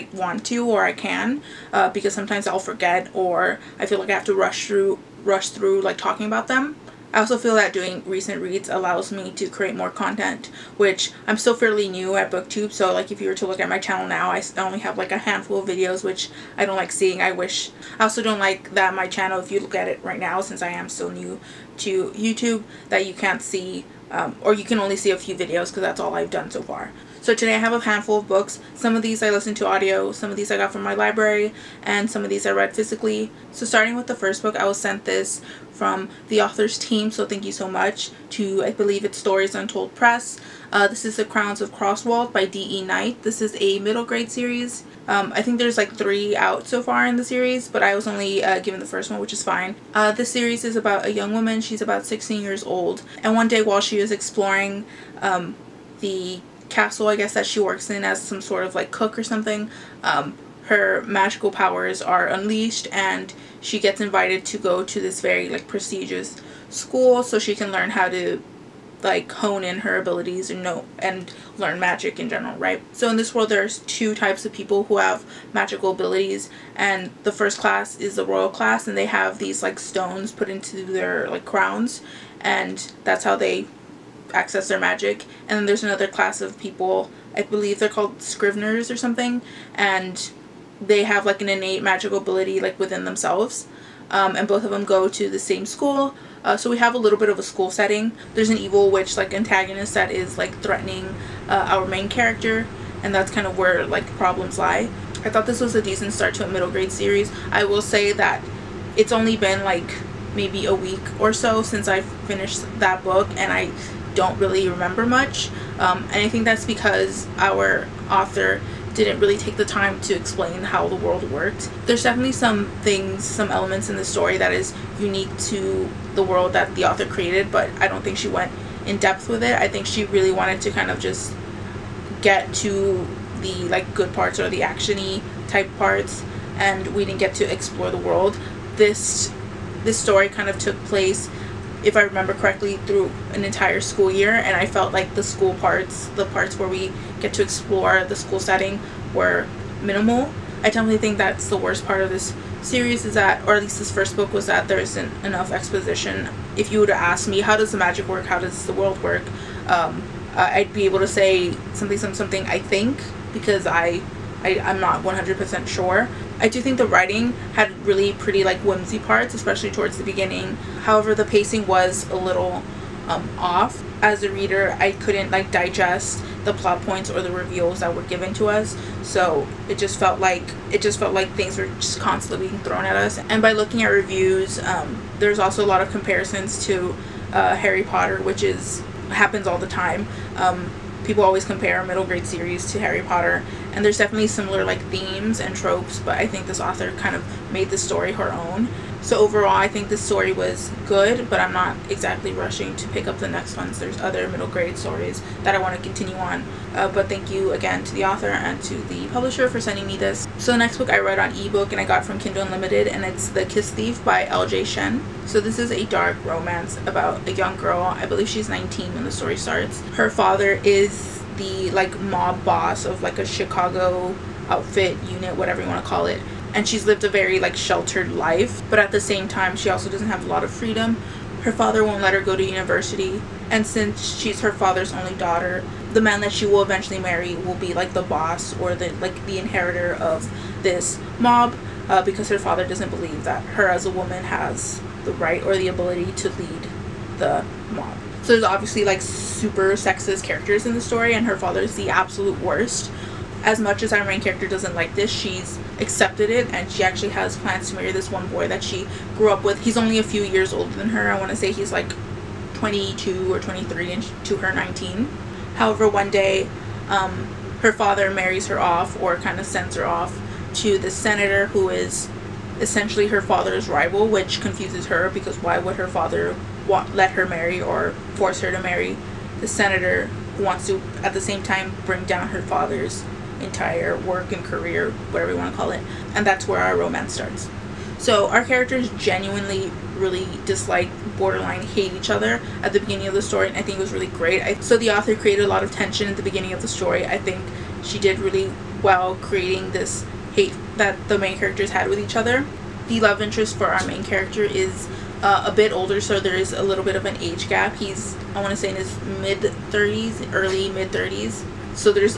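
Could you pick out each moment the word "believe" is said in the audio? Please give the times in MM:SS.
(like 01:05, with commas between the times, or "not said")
00:38, 01:27, 03:38, 04:02.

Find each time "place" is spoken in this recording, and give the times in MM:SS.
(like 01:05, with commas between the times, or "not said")
02:20.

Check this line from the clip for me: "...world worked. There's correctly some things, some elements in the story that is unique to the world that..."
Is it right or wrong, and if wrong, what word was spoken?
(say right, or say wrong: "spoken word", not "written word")
wrong: "definitely", not "correctly".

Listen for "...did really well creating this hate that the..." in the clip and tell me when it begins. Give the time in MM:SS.
04:57.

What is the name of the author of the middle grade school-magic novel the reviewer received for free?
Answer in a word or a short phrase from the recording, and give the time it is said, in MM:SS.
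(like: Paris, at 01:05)
D.E. Night, at 00:42.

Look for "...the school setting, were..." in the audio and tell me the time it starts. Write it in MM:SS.
02:28.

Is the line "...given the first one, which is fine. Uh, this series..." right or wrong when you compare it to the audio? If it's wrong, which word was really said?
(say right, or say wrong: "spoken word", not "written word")
right.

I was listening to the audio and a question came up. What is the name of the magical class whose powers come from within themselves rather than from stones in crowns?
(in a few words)
Scrivenists.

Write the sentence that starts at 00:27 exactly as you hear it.
So today I have a handful of books.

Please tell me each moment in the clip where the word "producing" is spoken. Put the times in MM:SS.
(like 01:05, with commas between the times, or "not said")
not said.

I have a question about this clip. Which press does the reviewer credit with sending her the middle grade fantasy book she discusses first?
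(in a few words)
Stories Untold Press.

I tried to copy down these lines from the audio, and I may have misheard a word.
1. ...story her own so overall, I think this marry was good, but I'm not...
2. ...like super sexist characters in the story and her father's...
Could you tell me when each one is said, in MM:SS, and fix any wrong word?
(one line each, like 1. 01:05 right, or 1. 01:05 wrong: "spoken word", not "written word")
1. 03:17 wrong: "story", not "marry"
2. 04:08 right.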